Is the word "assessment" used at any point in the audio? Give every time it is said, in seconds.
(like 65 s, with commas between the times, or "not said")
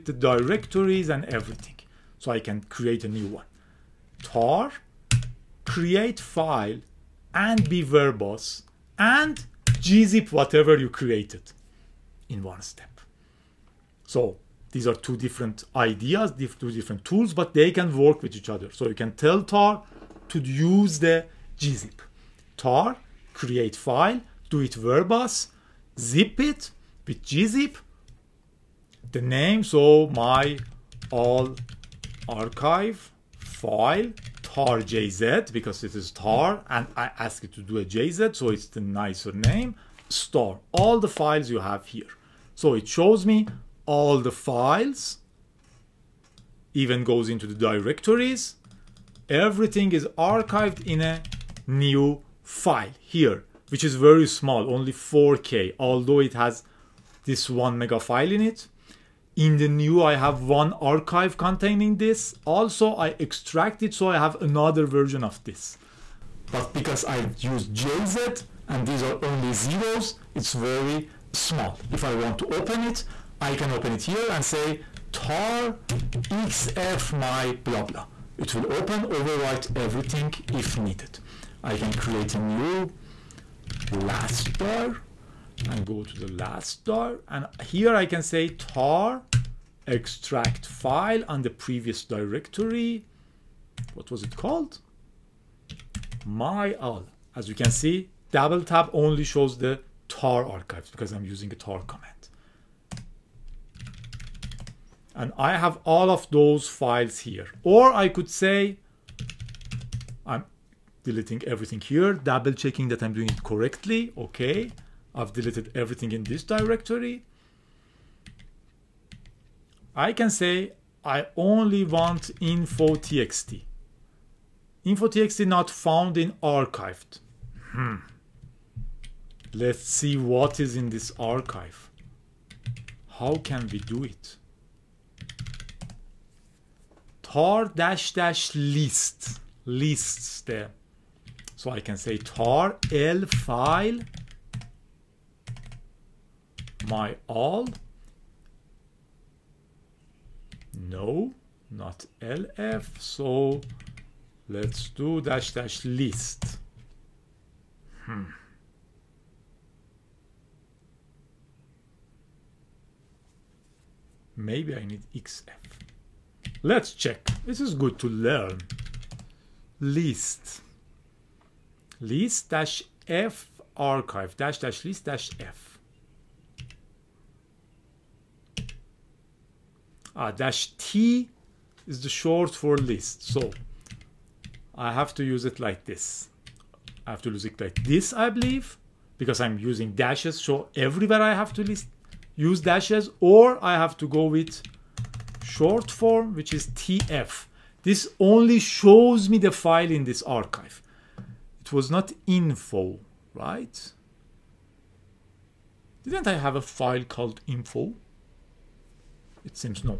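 not said.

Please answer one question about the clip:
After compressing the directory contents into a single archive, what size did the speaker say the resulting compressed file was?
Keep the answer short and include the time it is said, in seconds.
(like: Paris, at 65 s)
4k, at 54 s.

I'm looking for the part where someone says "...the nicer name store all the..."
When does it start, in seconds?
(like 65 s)
38 s.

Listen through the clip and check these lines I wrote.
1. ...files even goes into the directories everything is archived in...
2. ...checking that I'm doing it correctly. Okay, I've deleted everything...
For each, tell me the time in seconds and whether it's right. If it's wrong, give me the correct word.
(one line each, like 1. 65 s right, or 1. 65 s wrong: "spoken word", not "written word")
1. 44 s right
2. 112 s right.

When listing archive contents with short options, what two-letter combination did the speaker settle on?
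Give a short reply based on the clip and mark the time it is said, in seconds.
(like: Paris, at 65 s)
TF, at 196 s.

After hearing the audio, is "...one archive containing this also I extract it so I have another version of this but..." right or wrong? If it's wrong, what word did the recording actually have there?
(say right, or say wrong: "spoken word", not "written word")
right.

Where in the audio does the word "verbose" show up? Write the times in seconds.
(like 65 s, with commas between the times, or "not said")
7 s, 24 s.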